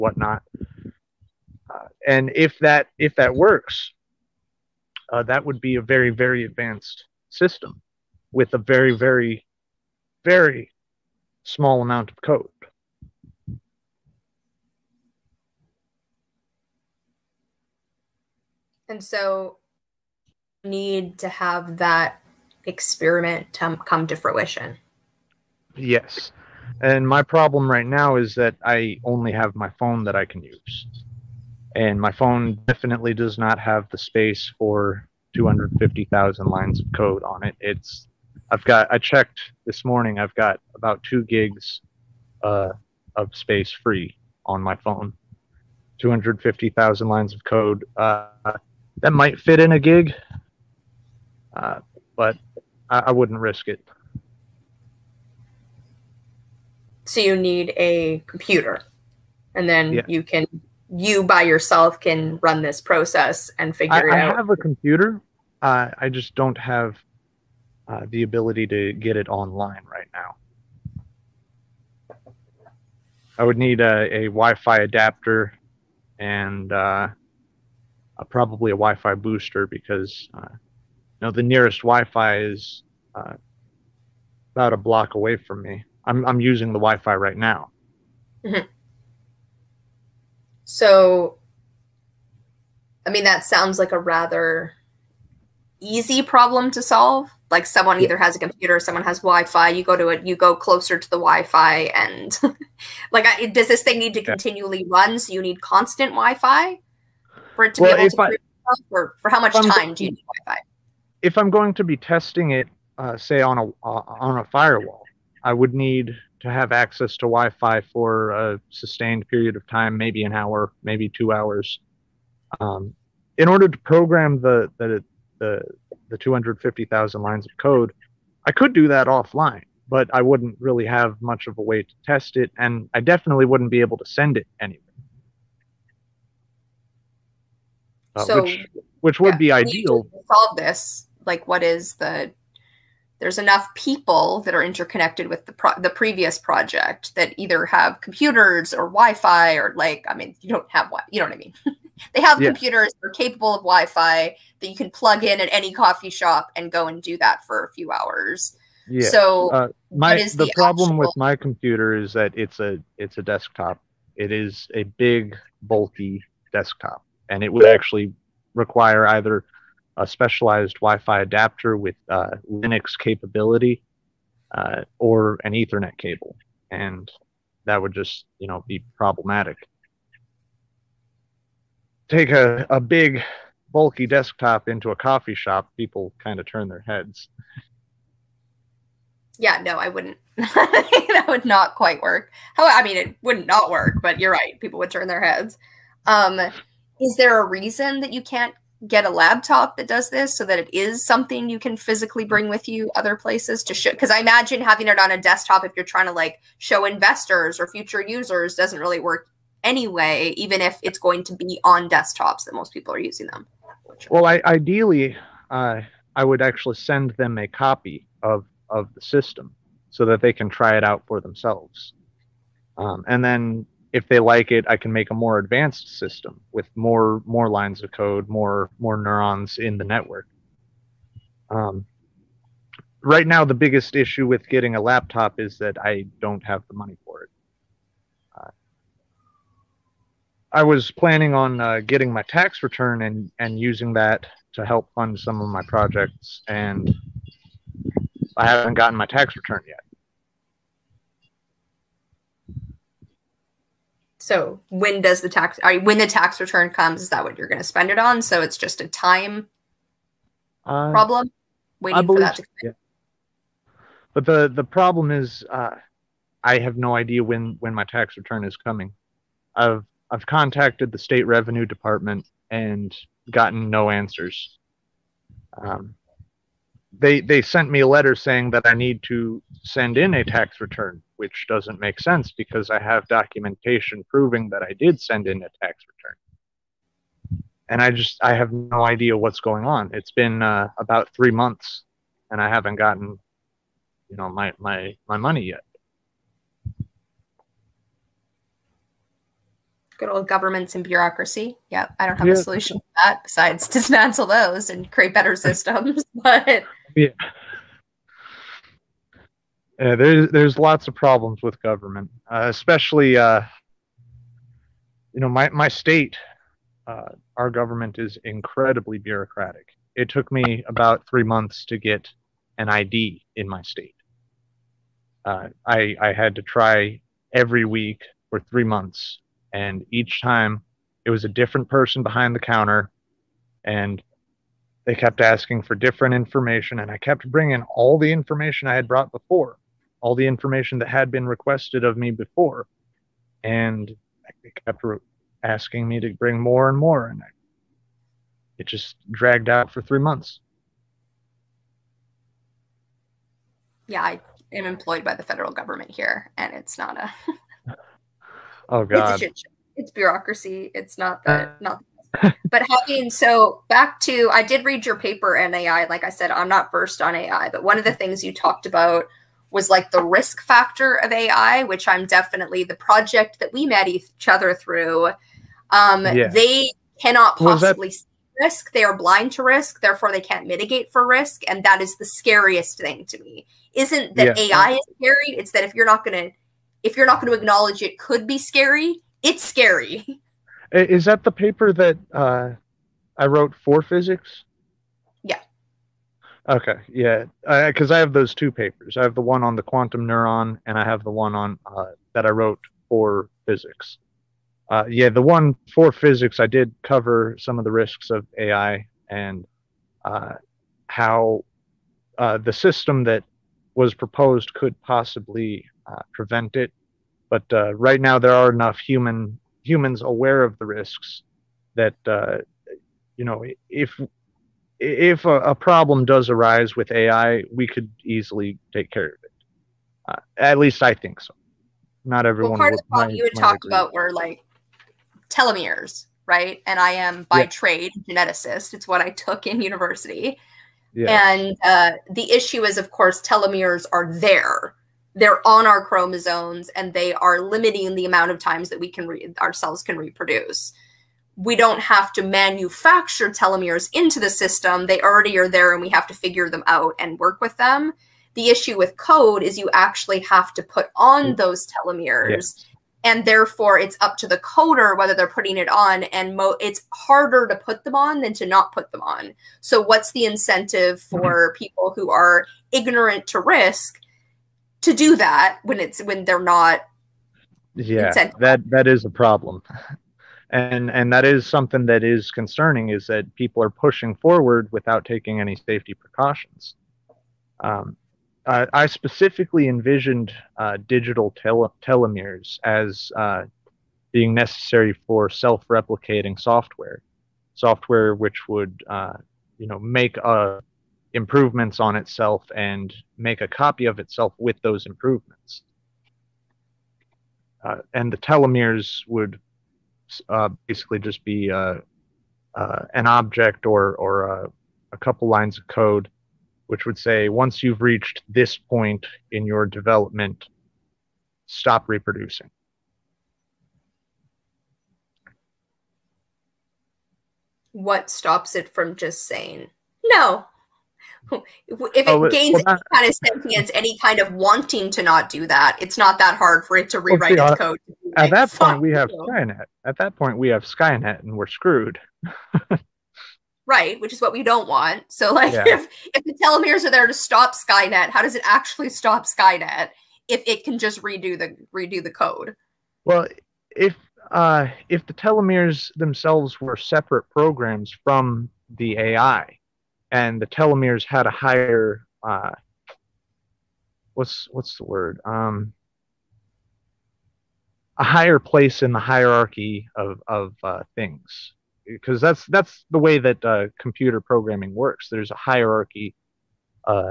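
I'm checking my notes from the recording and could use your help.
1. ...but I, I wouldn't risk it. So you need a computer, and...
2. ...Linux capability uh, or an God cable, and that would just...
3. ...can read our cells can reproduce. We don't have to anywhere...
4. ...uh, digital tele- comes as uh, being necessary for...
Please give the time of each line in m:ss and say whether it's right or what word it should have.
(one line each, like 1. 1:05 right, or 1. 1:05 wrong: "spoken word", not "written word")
1. 0:52 right
2. 2:52 wrong: "Ethernet", not "God"
3. 7:28 wrong: "manufacture", not "anywhere"
4. 8:10 wrong: "telomeres", not "comes".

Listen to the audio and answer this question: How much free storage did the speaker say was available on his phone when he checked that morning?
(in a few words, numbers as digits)
2 gigs.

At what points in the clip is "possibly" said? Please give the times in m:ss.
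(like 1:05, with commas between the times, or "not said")
6:17, 6:54.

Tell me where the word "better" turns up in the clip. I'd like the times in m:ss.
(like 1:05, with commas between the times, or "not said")
5:05.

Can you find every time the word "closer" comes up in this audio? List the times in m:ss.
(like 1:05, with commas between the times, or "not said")
1:40.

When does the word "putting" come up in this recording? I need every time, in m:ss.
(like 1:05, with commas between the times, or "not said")
7:45.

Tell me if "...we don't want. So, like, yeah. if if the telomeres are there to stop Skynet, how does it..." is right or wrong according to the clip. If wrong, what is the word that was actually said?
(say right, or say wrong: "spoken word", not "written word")
right.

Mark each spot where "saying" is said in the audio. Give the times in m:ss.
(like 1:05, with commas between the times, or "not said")
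4:38, 8:49.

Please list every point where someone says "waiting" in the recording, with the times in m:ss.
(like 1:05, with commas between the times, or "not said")
4:21.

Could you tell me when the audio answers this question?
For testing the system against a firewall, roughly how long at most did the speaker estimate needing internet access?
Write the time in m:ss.
2:00.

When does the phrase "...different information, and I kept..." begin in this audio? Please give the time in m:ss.
5:35.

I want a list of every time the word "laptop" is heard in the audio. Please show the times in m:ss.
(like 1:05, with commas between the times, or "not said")
3:19, 3:54.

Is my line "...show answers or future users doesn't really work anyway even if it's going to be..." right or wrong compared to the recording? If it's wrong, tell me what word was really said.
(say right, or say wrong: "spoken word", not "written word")
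wrong: "investors", not "answers".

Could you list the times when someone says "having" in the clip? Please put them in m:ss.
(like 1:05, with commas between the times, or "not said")
3:24, 6:02.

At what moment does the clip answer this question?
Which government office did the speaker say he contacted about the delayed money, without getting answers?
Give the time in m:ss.
4:30.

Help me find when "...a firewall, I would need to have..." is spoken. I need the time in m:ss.
1:54.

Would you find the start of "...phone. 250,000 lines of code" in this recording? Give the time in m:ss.
0:44.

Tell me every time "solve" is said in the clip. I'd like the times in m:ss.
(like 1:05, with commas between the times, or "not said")
1:36, 2:20.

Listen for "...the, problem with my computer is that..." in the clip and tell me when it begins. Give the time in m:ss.
2:40.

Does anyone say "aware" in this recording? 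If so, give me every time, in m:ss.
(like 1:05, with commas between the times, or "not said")
7:00.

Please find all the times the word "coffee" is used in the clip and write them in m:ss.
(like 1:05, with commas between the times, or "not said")
2:35, 3:04.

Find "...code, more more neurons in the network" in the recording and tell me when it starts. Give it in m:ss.
3:47.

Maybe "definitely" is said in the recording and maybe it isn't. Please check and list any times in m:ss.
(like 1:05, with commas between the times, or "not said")
0:32, 2:12, 6:12.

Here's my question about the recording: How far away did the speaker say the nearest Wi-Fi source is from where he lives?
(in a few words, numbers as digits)
a block.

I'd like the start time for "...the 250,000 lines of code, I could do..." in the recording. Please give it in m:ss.
2:06.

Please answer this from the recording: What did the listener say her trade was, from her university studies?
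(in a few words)
geneticist.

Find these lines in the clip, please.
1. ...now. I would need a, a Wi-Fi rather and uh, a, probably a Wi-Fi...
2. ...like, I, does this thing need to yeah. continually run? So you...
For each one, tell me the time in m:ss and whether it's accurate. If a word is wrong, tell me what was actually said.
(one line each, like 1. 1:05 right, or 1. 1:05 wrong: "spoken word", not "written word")
1. 1:10 wrong: "adapter", not "rather"
2. 1:43 right.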